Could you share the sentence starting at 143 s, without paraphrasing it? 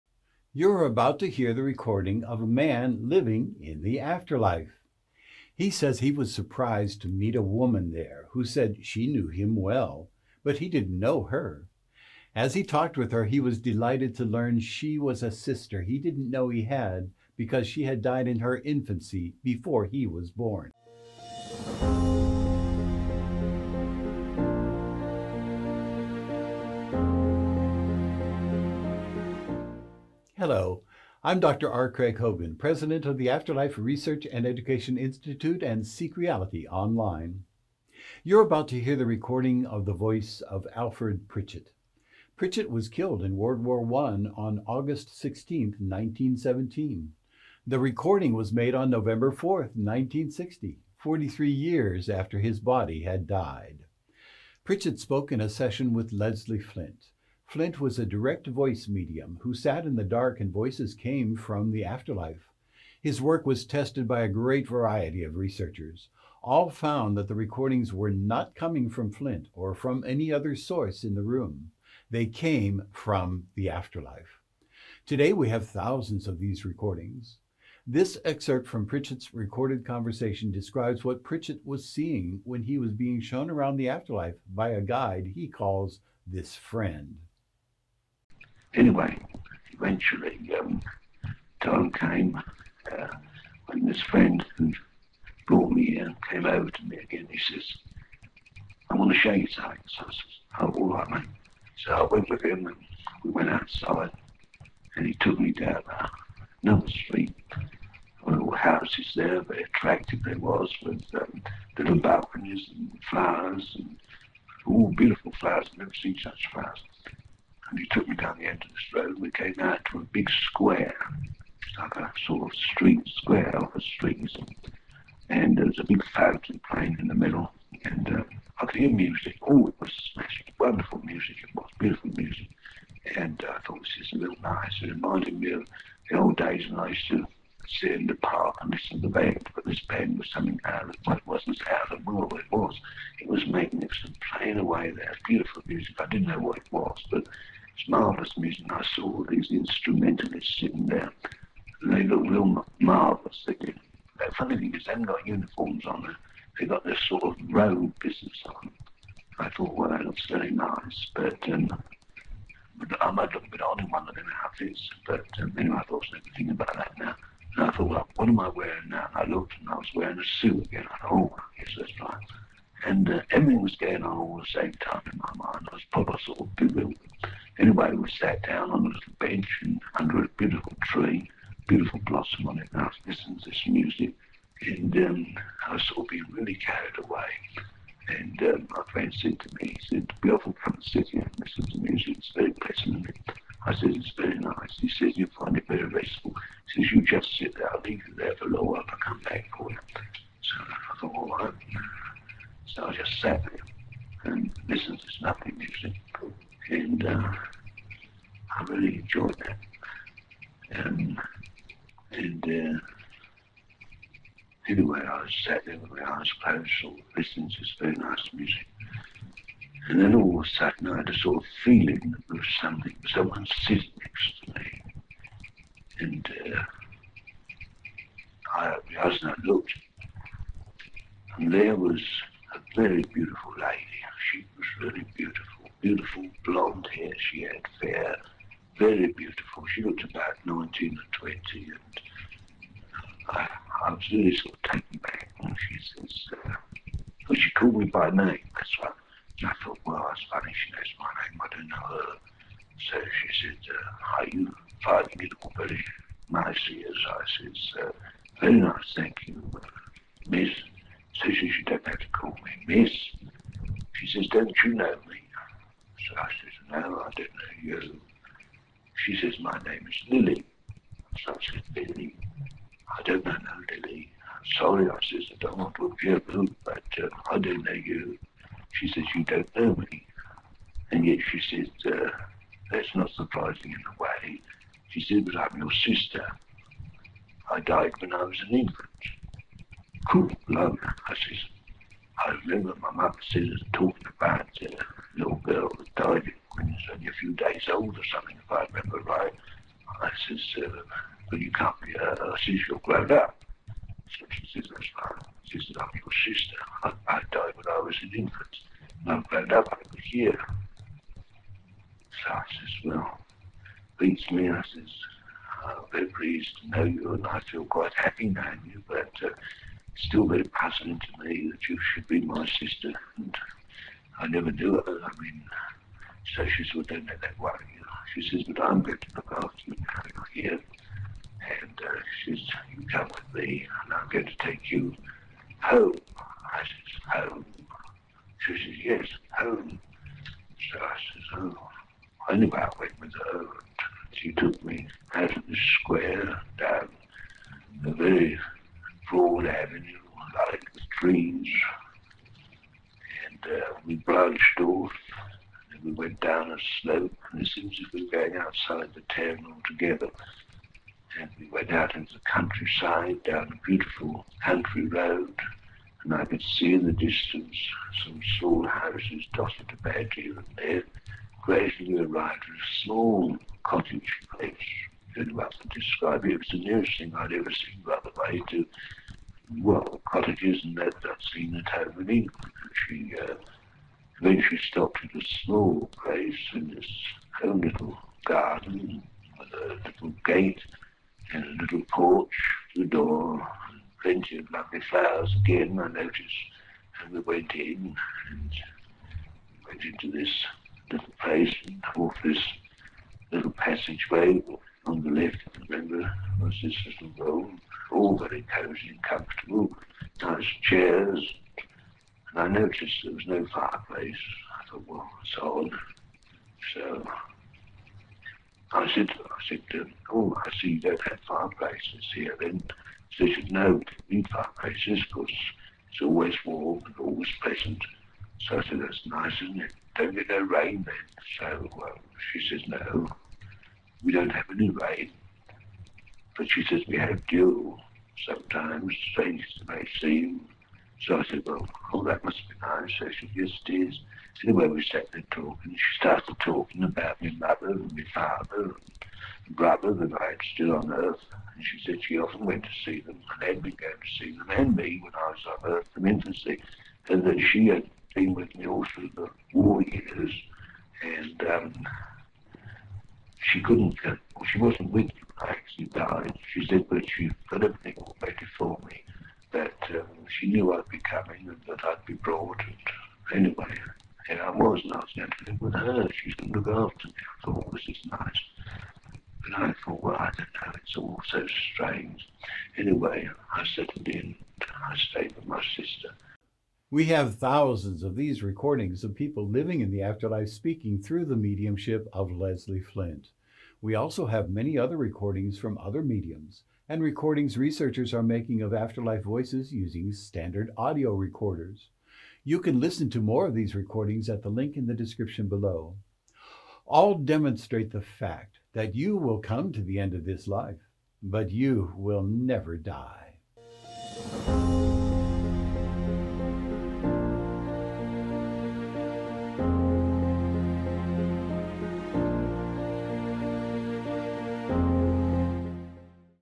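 It was magnificent, playing away there, beautiful music.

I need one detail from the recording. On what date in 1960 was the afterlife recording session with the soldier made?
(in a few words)
November 4, 1960.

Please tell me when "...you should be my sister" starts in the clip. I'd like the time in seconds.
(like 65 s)
321 s.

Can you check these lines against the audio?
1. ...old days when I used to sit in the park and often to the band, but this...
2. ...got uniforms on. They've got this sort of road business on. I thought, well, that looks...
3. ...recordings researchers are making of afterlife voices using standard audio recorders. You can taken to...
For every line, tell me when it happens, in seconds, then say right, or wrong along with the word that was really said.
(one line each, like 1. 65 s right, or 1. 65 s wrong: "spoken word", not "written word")
1. 136 s wrong: "listen", not "often"
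2. 155 s right
3. 497 s wrong: "listen", not "taken".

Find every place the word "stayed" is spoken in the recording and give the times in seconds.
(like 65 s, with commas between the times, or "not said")
484 s.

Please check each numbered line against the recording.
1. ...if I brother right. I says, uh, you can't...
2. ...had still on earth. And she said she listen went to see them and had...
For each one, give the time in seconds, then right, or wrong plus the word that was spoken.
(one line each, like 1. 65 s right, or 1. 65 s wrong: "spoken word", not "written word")
1. 298 s wrong: "remember", not "brother"
2. 450 s wrong: "often", not "listen".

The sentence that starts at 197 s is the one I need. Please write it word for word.
I'll leave you there for a little while.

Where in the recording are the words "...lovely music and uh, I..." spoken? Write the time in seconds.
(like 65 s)
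205 s.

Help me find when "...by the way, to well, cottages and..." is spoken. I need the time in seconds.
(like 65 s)
377 s.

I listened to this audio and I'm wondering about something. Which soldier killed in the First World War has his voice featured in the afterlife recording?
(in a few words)
Alfred Pritchett.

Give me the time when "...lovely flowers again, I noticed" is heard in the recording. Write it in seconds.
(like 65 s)
394 s.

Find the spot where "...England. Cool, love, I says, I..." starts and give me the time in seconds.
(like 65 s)
288 s.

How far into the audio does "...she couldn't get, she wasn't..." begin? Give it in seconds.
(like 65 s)
463 s.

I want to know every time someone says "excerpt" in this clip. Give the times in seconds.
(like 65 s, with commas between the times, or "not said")
78 s.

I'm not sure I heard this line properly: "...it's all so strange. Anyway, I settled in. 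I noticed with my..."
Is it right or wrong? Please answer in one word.
wrong.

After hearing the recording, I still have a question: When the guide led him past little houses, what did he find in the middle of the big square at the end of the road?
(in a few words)
a big fountain.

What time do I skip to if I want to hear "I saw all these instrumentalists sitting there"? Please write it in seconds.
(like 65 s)
148 s.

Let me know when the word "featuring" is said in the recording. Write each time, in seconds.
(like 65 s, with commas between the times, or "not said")
not said.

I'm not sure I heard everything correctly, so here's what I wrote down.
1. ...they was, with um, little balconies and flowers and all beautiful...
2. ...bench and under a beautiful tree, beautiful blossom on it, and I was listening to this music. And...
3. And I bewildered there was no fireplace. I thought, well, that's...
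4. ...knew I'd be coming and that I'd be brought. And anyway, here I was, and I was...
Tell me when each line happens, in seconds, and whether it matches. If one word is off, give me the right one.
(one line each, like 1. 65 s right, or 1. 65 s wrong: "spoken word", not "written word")
1. 110 s right
2. 179 s right
3. 412 s wrong: "noticed", not "bewildered"
4. 470 s right.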